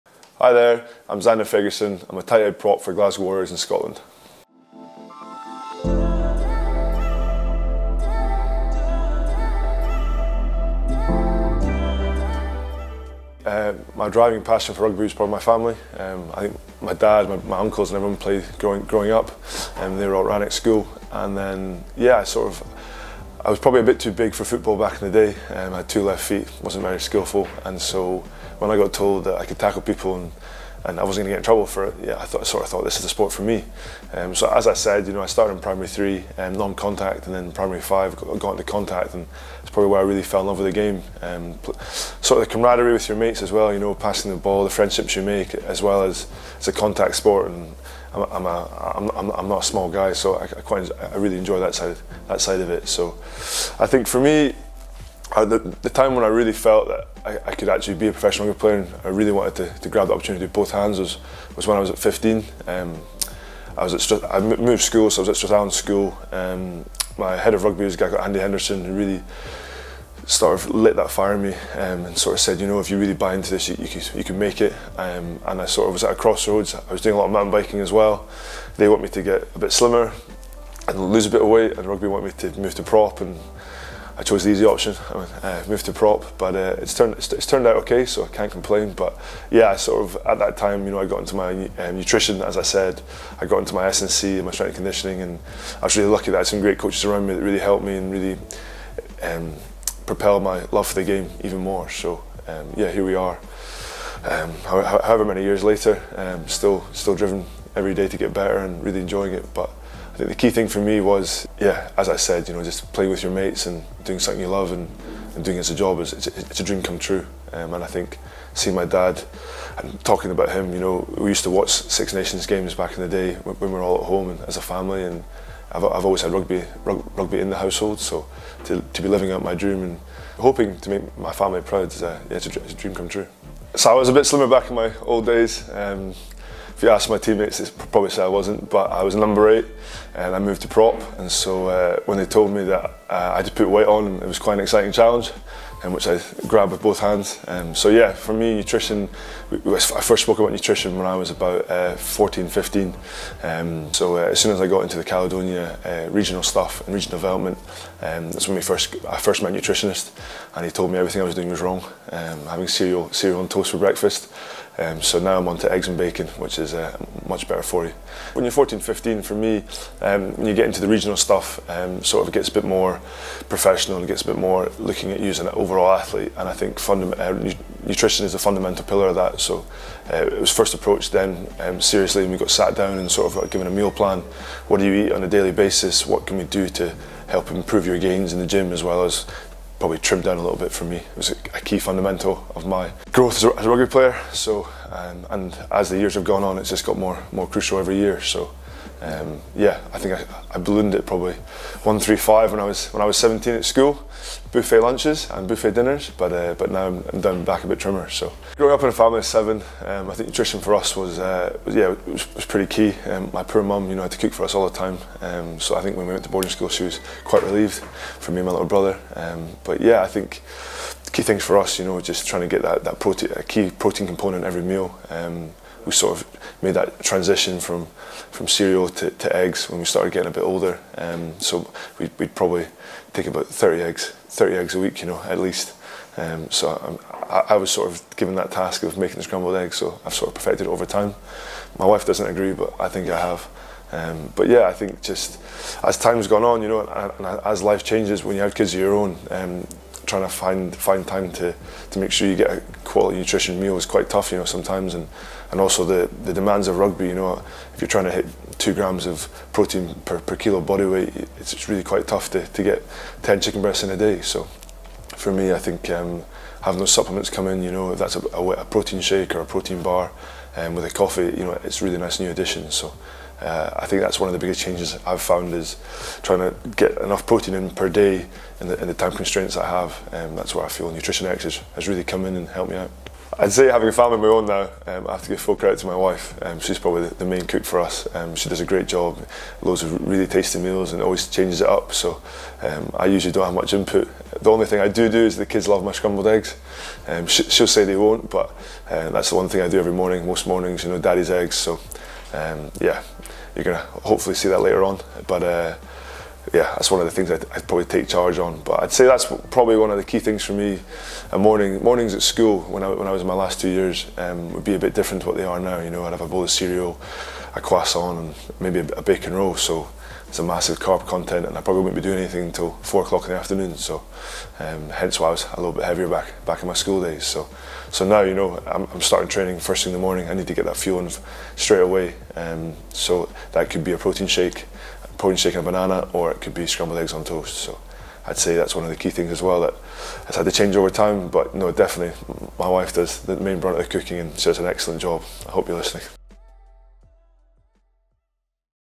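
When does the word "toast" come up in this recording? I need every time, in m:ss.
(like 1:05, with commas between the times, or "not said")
2:43, 5:37.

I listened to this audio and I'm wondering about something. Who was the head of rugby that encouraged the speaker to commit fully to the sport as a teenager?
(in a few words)
Andy Henderson.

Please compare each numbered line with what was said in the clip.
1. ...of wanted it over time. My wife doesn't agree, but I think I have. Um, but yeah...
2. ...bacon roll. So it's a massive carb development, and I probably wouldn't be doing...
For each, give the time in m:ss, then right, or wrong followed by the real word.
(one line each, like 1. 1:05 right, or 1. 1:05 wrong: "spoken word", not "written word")
1. 4:00 wrong: "perfected", not "wanted"
2. 5:19 wrong: "content", not "development".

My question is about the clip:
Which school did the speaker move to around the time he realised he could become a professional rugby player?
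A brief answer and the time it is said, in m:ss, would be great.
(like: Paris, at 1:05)
Strathallan School, at 1:05.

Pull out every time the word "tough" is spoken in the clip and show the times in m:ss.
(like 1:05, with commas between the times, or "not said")
4:14, 4:22.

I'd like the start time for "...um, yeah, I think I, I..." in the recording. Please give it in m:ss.
3:19.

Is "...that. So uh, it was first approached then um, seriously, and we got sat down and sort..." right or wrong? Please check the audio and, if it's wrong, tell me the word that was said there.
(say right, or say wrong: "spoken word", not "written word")
right.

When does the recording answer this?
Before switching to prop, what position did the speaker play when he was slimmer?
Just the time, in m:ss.
2:19.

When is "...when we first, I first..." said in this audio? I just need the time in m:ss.
2:38.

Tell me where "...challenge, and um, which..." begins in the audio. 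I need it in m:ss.
2:24.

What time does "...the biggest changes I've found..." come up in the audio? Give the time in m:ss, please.
4:34.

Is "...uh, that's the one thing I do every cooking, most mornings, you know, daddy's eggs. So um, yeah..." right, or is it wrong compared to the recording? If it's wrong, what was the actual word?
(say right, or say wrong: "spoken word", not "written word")
wrong: "morning", not "cooking".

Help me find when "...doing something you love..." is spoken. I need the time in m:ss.
1:54.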